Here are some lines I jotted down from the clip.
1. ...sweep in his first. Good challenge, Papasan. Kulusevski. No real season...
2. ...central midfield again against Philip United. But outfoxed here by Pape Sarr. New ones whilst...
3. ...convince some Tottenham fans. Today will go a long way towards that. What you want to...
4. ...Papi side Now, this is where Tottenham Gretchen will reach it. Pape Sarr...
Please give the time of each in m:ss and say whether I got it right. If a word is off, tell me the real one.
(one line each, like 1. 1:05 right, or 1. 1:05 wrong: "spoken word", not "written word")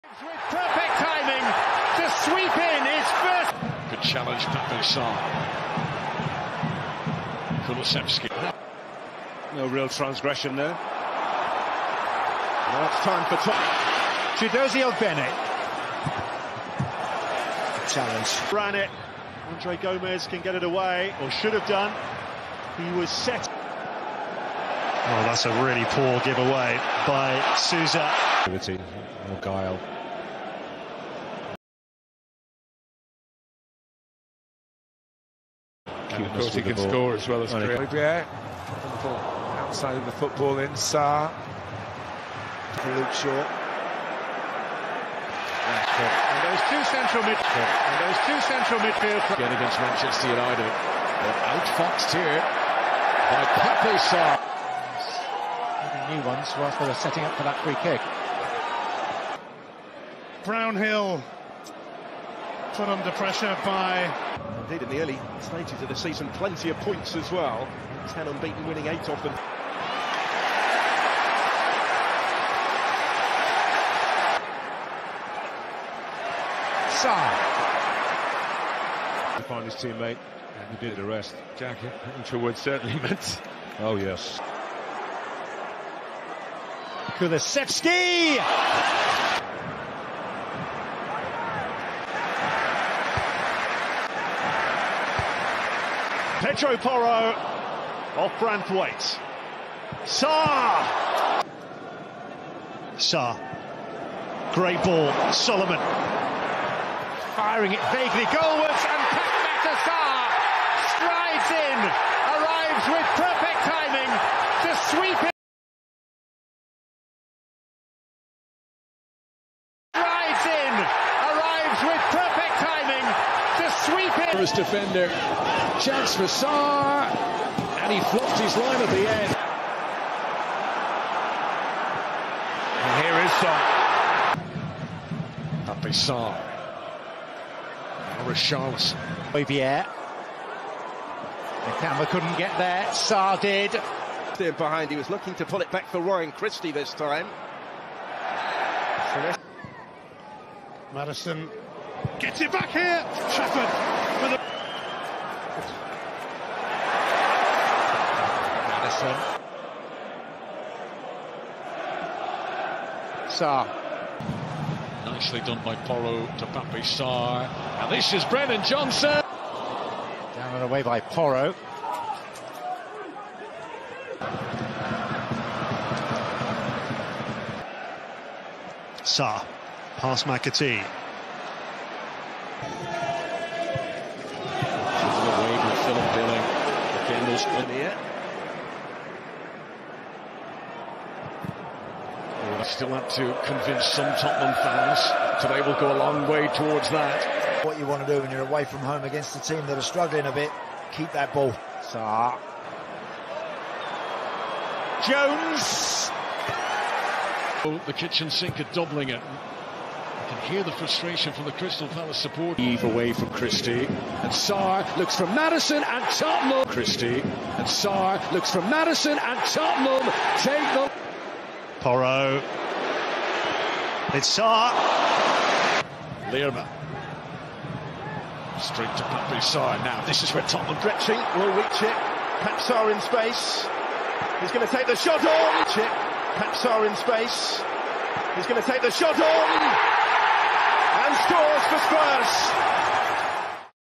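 1. 0:02 wrong: "transgression", not "season"
2. 0:48 wrong: "Manchester", not "Philip"
3. 3:13 right
4. 3:49 right.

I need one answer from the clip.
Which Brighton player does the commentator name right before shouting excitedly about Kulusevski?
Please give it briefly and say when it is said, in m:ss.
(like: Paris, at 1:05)
Jack Hinshelwood, at 1:21.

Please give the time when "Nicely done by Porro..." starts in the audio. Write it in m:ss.
2:45.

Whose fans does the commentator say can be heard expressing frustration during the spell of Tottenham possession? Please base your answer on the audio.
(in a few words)
Crystal Palace.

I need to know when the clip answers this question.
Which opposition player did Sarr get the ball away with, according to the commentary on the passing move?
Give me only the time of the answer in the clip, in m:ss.
3:05.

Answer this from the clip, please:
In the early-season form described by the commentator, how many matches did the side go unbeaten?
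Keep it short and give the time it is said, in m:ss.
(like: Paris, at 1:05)
10, at 1:08.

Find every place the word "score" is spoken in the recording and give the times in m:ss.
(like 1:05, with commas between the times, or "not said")
0:36, 4:01.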